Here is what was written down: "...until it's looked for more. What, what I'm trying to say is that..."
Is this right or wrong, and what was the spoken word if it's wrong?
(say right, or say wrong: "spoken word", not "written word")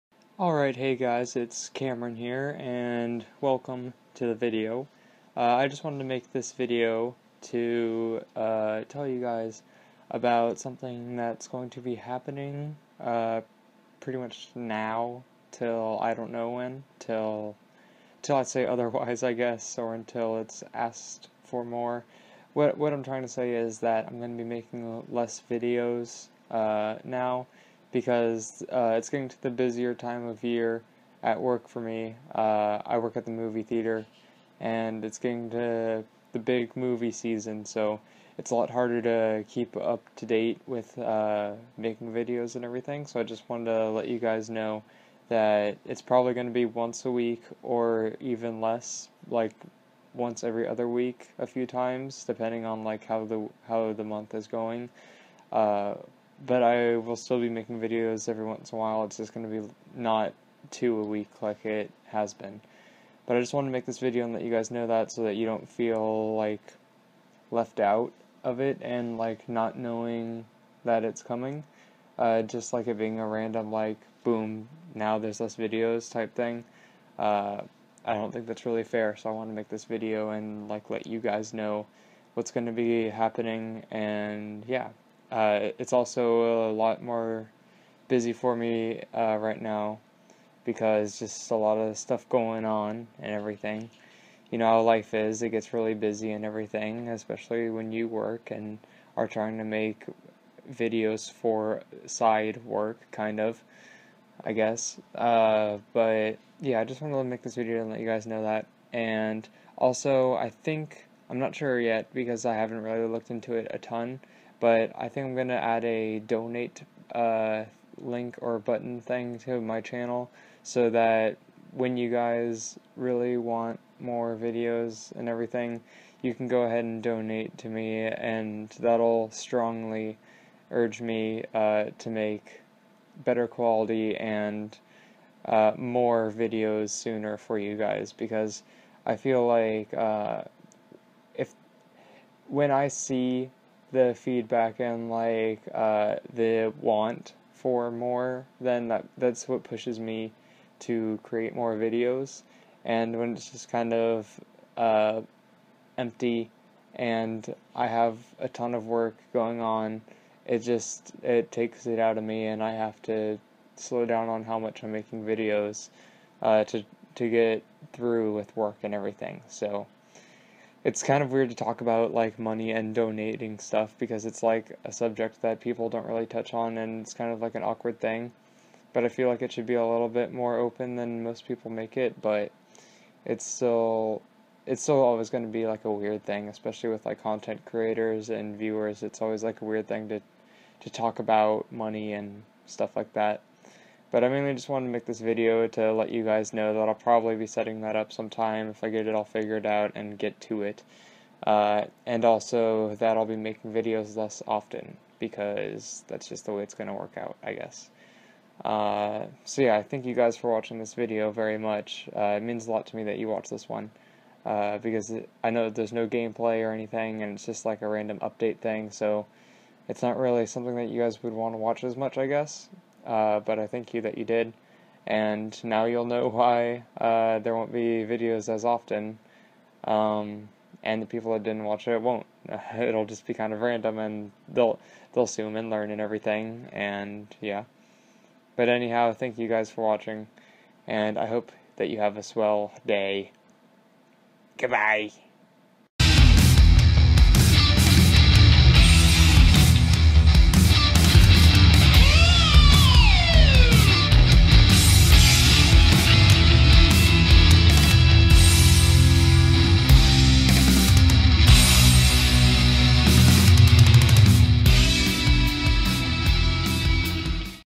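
wrong: "asked", not "looked".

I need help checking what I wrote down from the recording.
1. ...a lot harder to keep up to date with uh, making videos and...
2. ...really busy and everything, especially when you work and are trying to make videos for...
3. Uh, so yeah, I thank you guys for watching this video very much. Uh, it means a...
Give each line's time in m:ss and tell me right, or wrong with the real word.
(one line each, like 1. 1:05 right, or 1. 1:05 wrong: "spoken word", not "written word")
1. 0:38 right
2. 1:35 right
3. 3:28 right.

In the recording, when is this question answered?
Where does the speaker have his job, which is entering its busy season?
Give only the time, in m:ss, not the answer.
0:33.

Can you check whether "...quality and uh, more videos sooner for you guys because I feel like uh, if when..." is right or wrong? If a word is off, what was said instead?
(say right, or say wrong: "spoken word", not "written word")
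right.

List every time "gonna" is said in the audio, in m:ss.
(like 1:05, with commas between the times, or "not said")
1:55.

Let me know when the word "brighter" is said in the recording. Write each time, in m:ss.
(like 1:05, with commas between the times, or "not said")
not said.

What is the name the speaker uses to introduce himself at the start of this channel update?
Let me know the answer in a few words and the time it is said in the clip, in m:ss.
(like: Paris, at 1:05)
Cameron, at 0:01.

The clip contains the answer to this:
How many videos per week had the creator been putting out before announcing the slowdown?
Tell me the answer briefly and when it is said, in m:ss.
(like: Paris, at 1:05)
2, at 1:00.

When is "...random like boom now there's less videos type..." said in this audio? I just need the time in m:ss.
1:13.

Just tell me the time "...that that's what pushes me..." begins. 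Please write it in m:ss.
2:28.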